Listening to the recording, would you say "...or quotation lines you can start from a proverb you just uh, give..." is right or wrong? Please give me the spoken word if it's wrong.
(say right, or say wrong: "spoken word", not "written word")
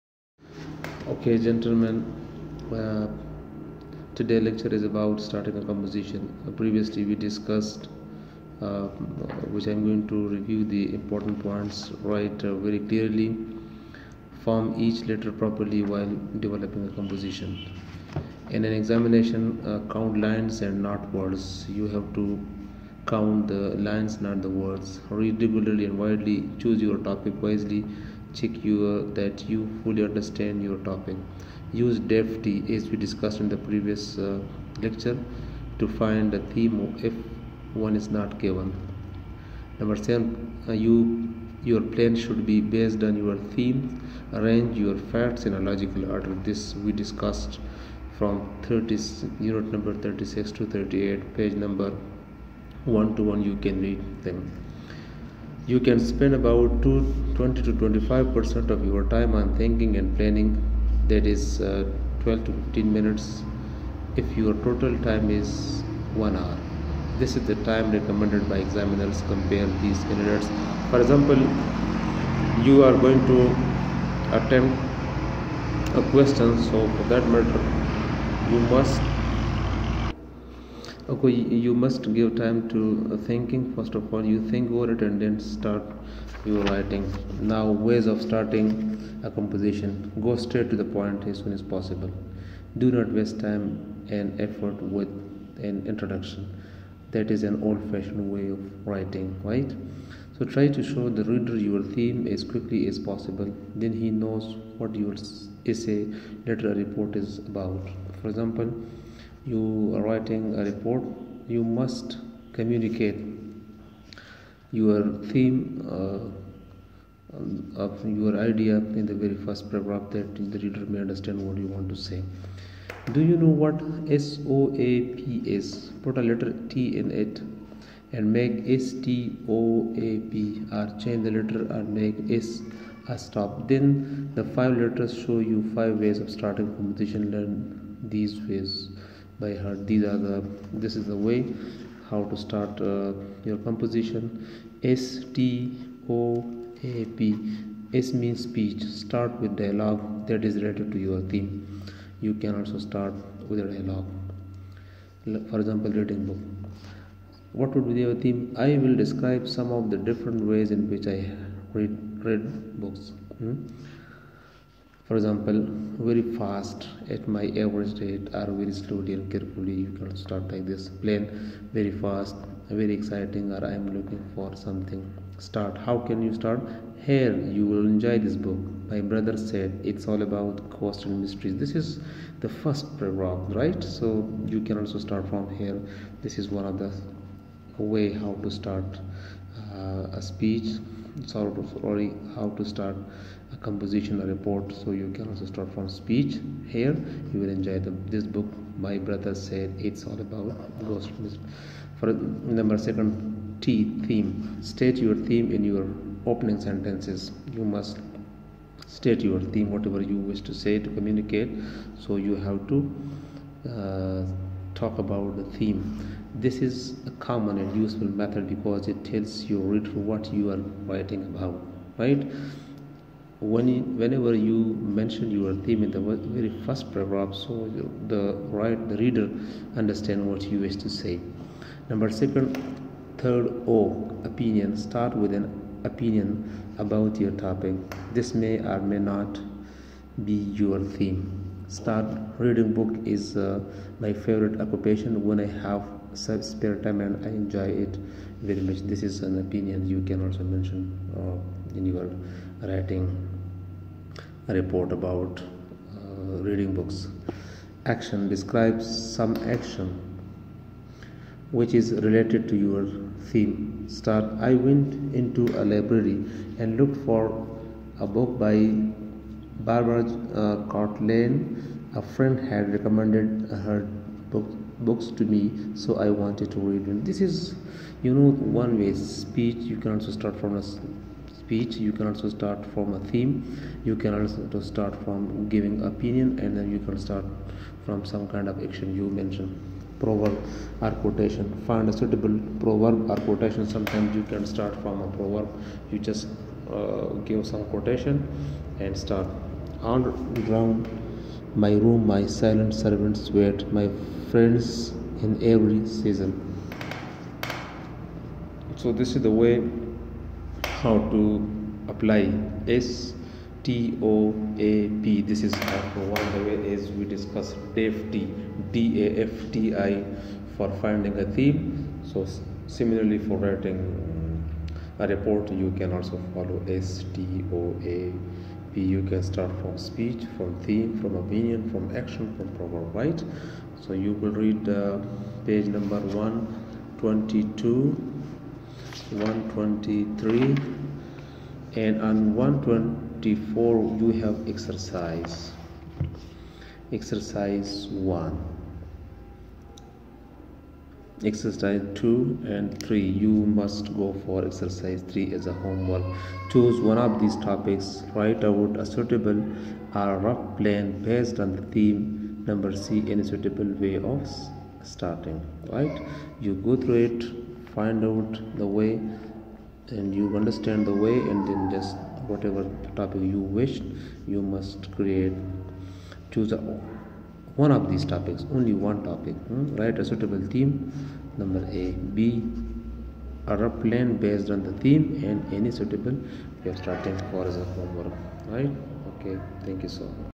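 wrong: "sometimes", not "lines".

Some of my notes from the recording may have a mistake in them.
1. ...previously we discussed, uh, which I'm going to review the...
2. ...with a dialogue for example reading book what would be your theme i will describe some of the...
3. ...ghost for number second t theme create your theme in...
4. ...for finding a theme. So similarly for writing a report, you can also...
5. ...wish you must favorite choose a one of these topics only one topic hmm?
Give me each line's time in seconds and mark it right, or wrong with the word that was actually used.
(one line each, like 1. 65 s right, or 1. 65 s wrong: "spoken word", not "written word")
1. 6 s right
2. 153 s right
3. 200 s wrong: "state", not "create"
4. 320 s right
5. 373 s wrong: "create", not "favorite".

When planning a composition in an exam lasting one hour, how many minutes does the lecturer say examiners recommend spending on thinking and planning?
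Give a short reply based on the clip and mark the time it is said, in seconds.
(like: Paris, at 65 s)
12 to 15, at 62 s.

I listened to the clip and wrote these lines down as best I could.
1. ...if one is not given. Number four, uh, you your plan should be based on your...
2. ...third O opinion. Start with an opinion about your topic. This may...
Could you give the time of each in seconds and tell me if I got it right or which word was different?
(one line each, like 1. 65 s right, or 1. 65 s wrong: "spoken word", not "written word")
1. 37 s wrong: "seven", not "four"
2. 233 s right.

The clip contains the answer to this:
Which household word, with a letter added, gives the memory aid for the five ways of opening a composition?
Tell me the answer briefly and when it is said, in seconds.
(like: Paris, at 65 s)
soap, at 124 s.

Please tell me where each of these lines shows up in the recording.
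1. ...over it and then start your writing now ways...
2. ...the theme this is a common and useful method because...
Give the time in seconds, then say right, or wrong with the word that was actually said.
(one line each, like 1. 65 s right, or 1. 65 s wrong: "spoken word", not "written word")
1. 84 s right
2. 215 s right.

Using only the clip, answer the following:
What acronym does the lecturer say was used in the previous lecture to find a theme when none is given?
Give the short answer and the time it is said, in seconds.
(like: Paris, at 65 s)
DEFT, at 31 s.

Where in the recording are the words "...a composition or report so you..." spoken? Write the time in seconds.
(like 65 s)
193 s.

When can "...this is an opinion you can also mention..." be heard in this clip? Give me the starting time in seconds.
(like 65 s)
248 s.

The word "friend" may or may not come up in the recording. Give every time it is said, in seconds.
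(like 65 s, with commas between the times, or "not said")
272 s, 304 s.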